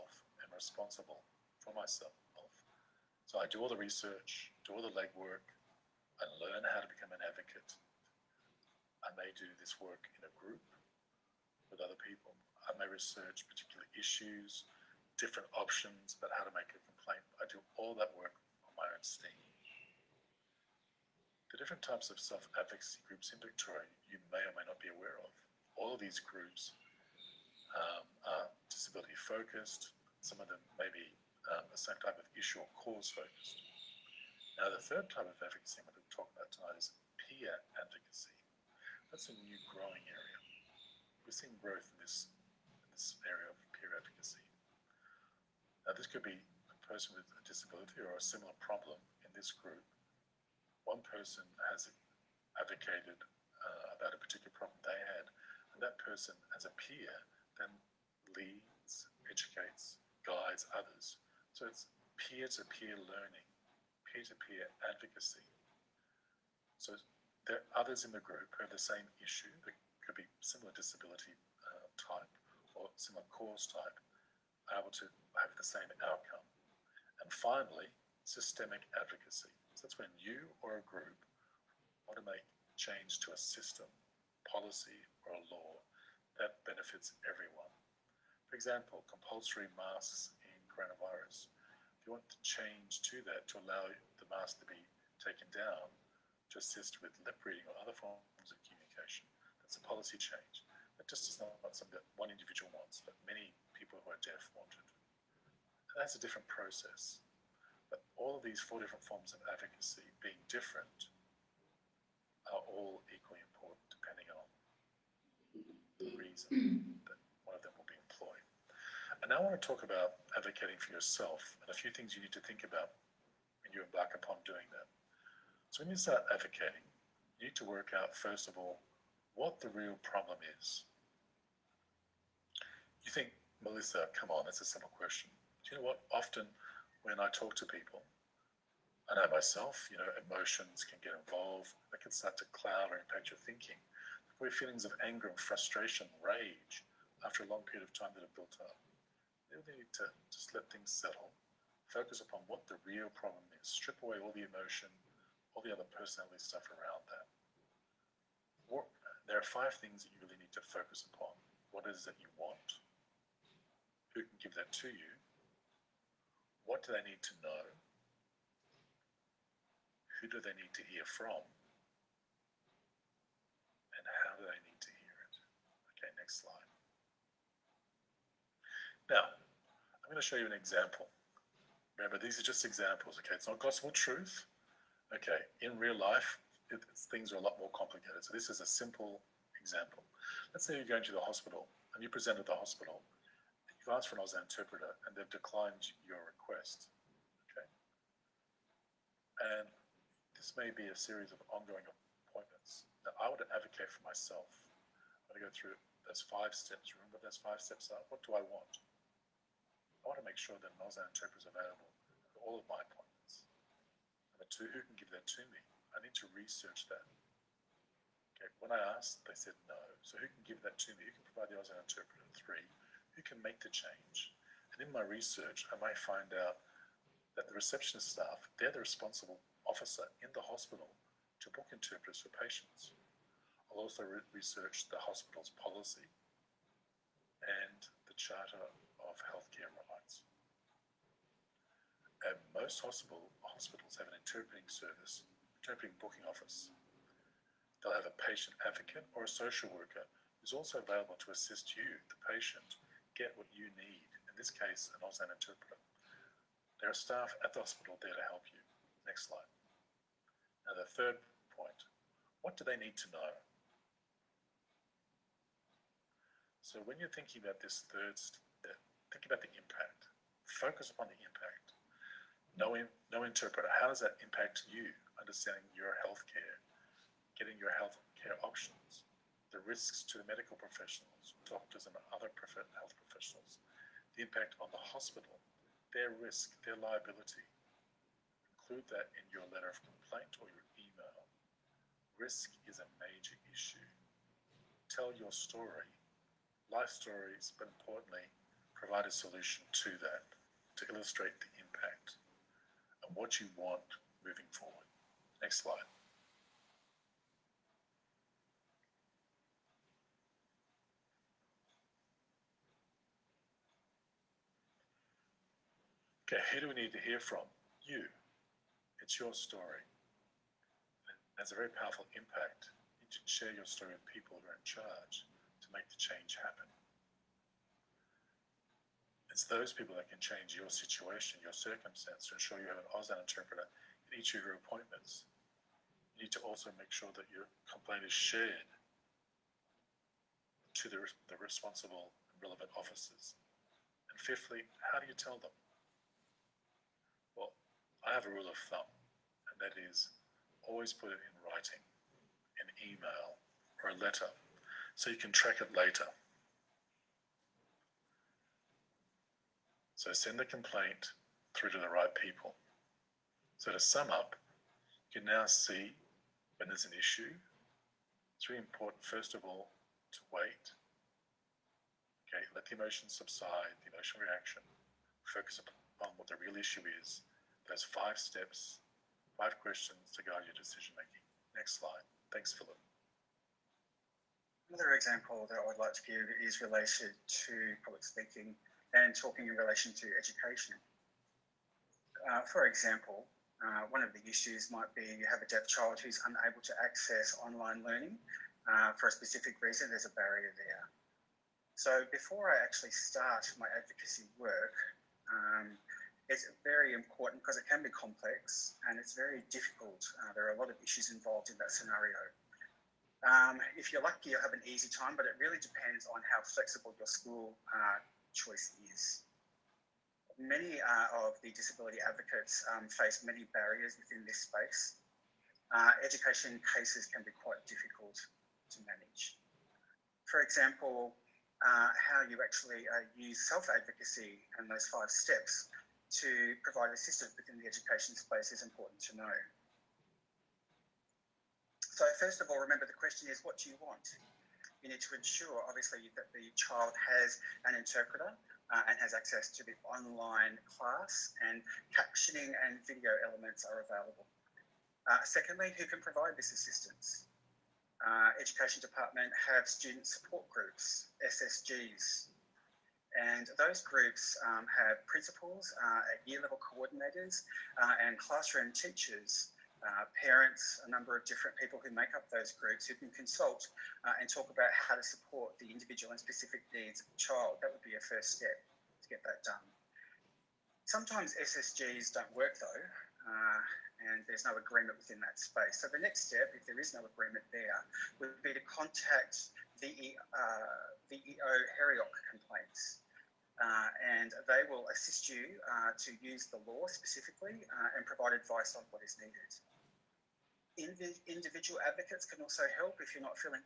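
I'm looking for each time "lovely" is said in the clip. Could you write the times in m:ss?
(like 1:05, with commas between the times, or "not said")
not said.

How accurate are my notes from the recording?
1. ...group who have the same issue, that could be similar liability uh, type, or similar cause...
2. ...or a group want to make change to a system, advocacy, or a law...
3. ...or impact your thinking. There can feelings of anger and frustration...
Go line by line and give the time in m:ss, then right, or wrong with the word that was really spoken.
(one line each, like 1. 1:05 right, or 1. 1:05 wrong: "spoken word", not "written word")
1. 1:08 wrong: "disability", not "liability"
2. 1:20 wrong: "policy", not "advocacy"
3. 2:22 right.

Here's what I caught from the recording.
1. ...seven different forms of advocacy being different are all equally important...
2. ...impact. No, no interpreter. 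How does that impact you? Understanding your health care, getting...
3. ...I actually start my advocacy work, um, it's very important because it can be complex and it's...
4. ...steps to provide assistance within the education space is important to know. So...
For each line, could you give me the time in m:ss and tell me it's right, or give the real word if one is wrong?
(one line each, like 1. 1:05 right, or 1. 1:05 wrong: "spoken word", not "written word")
1. 1:48 wrong: "four", not "seven"
2. 4:31 right
3. 6:42 right
4. 7:15 right.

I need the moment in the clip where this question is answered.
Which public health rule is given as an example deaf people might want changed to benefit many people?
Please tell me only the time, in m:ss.
1:29.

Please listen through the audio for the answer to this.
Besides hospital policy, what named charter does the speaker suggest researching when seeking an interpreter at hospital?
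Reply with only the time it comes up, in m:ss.
3:58.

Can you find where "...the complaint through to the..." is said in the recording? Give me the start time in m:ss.
6:00.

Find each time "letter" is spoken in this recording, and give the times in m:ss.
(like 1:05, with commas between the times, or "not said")
4:49, 5:54.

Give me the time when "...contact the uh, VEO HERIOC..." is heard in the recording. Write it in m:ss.
8:08.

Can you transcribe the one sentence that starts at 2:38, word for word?
What, there are five things that you really need to focus upon.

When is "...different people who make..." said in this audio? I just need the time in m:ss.
7:51.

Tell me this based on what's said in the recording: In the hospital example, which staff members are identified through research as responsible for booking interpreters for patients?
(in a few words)
Receptionist staff.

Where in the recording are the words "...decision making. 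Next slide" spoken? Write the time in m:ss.
6:20.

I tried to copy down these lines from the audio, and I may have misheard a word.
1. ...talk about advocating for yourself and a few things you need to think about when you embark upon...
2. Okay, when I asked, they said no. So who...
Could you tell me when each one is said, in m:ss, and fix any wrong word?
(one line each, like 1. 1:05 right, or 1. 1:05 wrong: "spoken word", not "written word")
1. 1:59 right
2. 3:38 right.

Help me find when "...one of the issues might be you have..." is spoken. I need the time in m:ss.
6:33.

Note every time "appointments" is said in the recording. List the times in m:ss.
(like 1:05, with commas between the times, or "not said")
3:22, 3:32, 5:34.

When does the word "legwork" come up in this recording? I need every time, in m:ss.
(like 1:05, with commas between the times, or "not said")
0:04.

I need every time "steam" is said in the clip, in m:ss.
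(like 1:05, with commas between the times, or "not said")
0:19.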